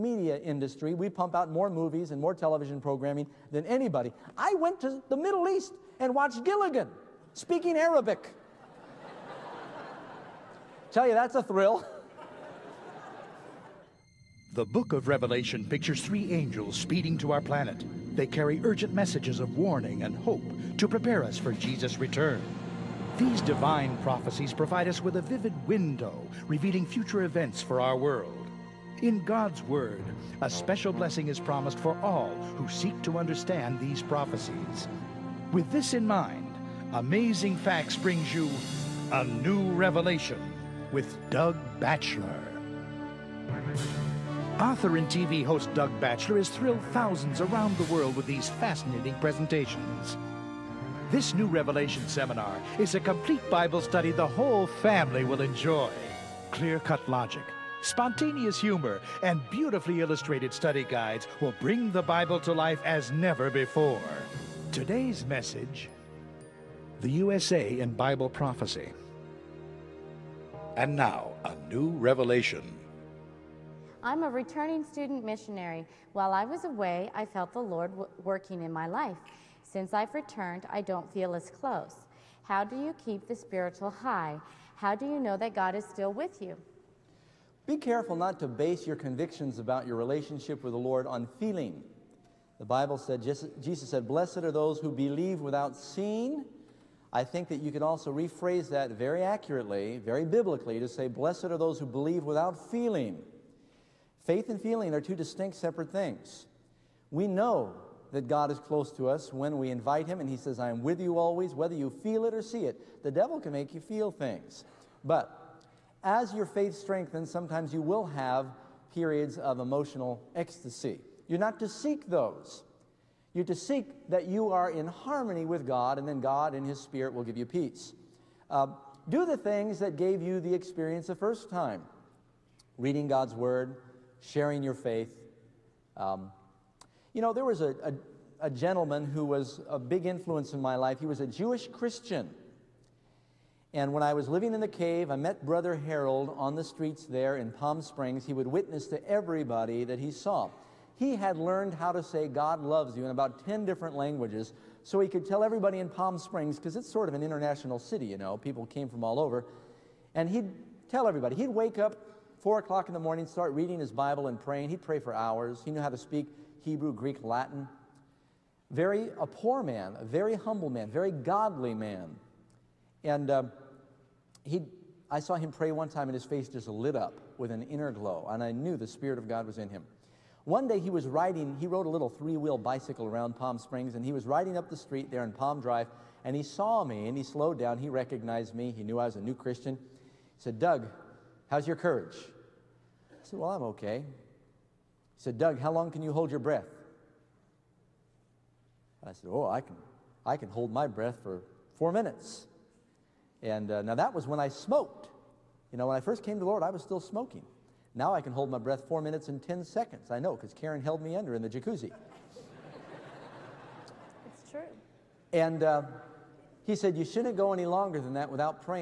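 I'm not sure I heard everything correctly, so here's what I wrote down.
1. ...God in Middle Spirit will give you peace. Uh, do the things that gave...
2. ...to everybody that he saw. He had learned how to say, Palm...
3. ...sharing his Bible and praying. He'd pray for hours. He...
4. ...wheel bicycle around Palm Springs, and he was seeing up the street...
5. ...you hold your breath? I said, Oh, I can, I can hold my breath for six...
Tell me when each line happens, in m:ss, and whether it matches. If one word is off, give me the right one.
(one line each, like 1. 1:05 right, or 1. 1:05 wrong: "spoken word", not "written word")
1. 2:06 wrong: "His", not "Middle"
2. 2:28 wrong: "God", not "Palm"
3. 2:43 wrong: "reading", not "sharing"
4. 3:02 wrong: "riding", not "seeing"
5. 3:16 wrong: "four", not "six".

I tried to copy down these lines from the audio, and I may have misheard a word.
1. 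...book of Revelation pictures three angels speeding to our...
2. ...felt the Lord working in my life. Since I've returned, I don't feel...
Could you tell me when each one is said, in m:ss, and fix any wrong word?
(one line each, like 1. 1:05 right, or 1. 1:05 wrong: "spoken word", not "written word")
1. 0:14 right
2. 1:17 right.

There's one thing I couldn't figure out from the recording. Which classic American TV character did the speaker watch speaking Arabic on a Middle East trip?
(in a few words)
Gilligan.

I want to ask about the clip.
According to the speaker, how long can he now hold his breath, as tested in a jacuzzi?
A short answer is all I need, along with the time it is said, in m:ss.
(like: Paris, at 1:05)
4 minutes and 10 seconds, at 3:28.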